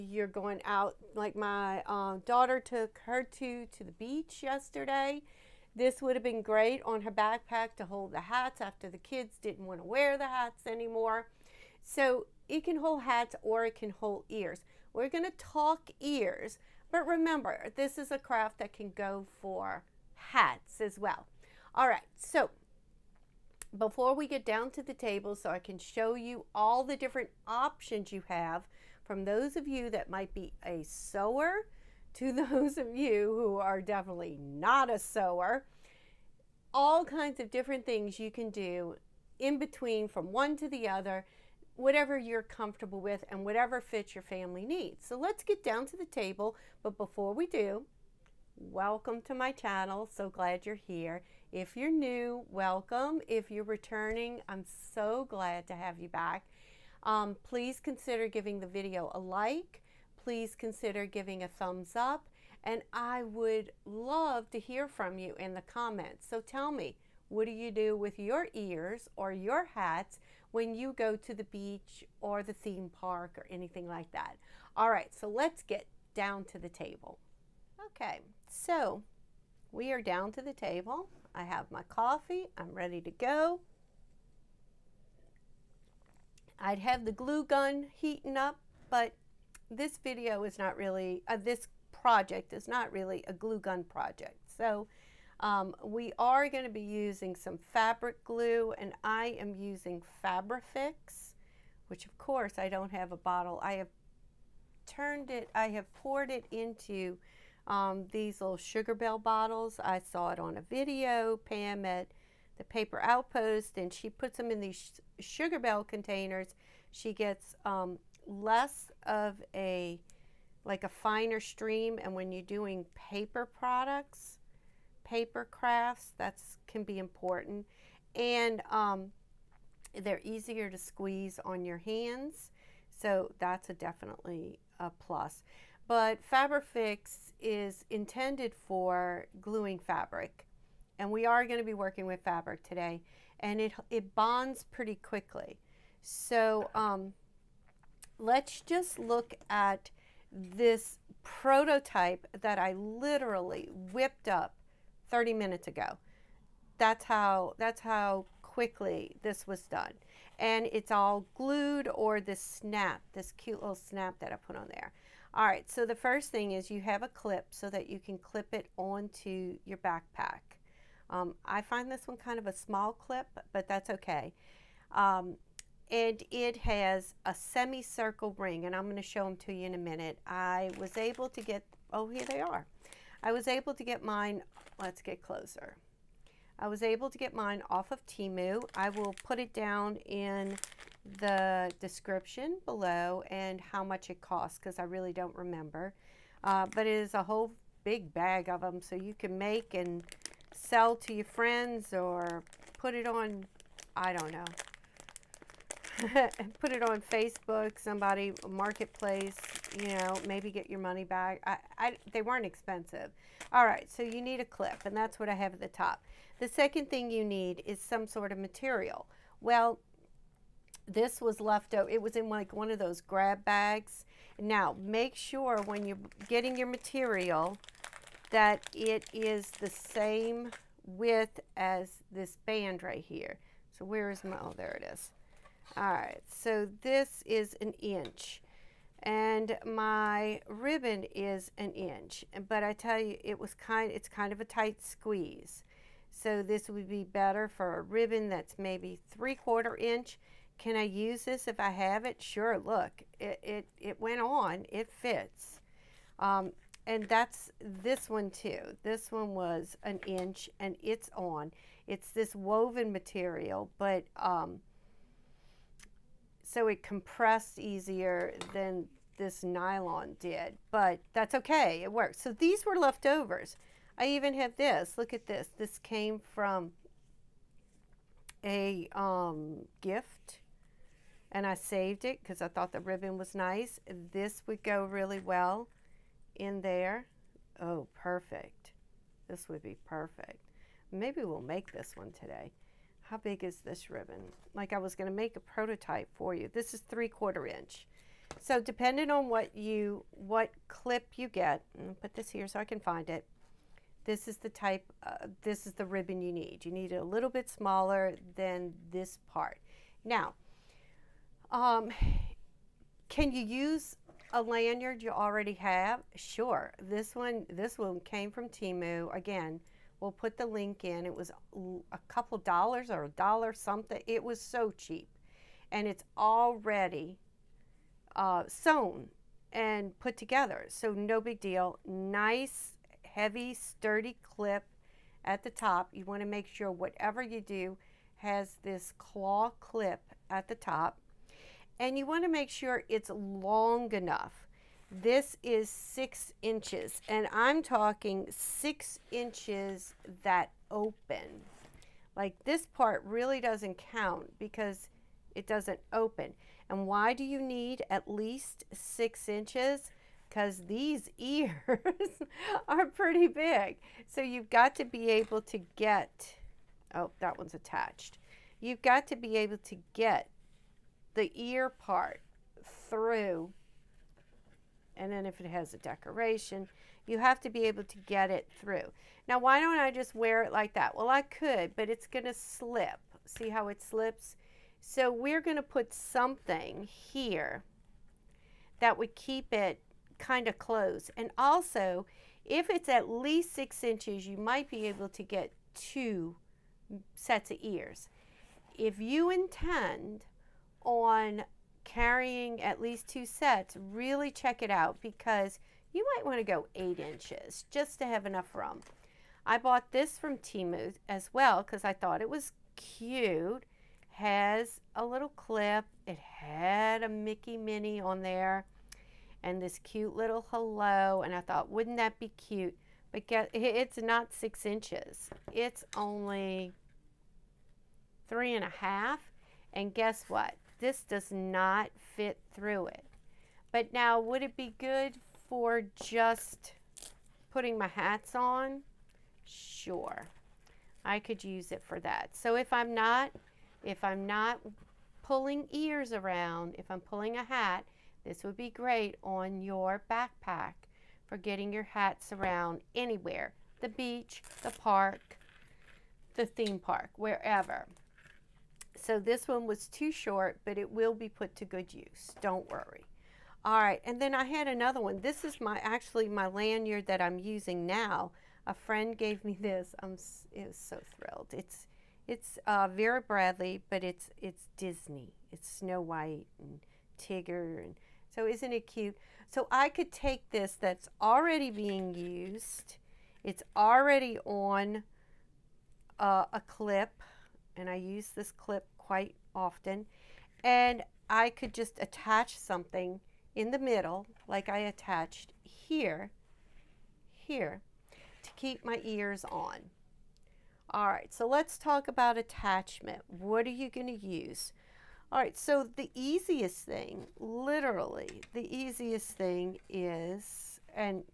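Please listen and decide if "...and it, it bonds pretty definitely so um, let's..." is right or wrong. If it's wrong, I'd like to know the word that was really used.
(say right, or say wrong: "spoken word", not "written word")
wrong: "quickly", not "definitely".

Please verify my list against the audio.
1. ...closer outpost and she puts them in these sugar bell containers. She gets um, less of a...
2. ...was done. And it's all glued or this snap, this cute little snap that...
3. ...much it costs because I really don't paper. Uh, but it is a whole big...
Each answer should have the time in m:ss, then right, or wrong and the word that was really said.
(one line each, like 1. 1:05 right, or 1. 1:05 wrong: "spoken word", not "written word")
1. 1:52 wrong: "paper", not "closer"
2. 2:39 right
3. 3:13 wrong: "remember", not "paper".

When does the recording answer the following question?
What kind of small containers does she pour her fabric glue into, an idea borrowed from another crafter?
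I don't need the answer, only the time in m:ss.
1:48.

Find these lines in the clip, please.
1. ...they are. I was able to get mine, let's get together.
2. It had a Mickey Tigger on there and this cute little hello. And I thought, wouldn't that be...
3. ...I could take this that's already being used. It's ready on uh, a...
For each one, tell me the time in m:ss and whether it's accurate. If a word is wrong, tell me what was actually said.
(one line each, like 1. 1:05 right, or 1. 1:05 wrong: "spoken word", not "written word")
1. 3:02 wrong: "closer", not "together"
2. 6:56 wrong: "Minnie", not "Tigger"
3. 7:59 wrong: "already", not "ready".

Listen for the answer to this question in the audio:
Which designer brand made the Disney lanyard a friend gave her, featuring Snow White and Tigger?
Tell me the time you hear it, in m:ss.
7:52.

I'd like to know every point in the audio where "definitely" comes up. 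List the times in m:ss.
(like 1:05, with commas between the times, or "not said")
0:33, 2:13.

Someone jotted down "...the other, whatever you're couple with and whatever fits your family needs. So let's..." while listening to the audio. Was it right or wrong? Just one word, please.
wrong.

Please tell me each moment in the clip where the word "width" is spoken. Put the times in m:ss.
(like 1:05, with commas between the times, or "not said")
3:50.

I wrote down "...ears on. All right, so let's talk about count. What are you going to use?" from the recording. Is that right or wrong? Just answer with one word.
wrong.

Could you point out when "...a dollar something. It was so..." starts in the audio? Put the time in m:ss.
5:23.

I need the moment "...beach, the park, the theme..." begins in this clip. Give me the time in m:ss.
7:33.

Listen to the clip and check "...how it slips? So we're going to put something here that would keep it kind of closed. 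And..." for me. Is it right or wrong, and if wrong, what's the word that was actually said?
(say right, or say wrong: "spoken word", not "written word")
right.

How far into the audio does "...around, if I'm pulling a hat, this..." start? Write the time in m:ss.
7:26.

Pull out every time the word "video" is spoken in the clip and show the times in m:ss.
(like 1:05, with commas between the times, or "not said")
0:58, 1:29, 1:50.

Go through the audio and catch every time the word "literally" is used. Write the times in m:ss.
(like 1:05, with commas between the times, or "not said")
2:32, 8:27.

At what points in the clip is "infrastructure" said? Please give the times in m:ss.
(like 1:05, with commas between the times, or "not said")
not said.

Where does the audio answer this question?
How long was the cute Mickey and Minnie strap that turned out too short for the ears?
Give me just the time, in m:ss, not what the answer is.
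7:08.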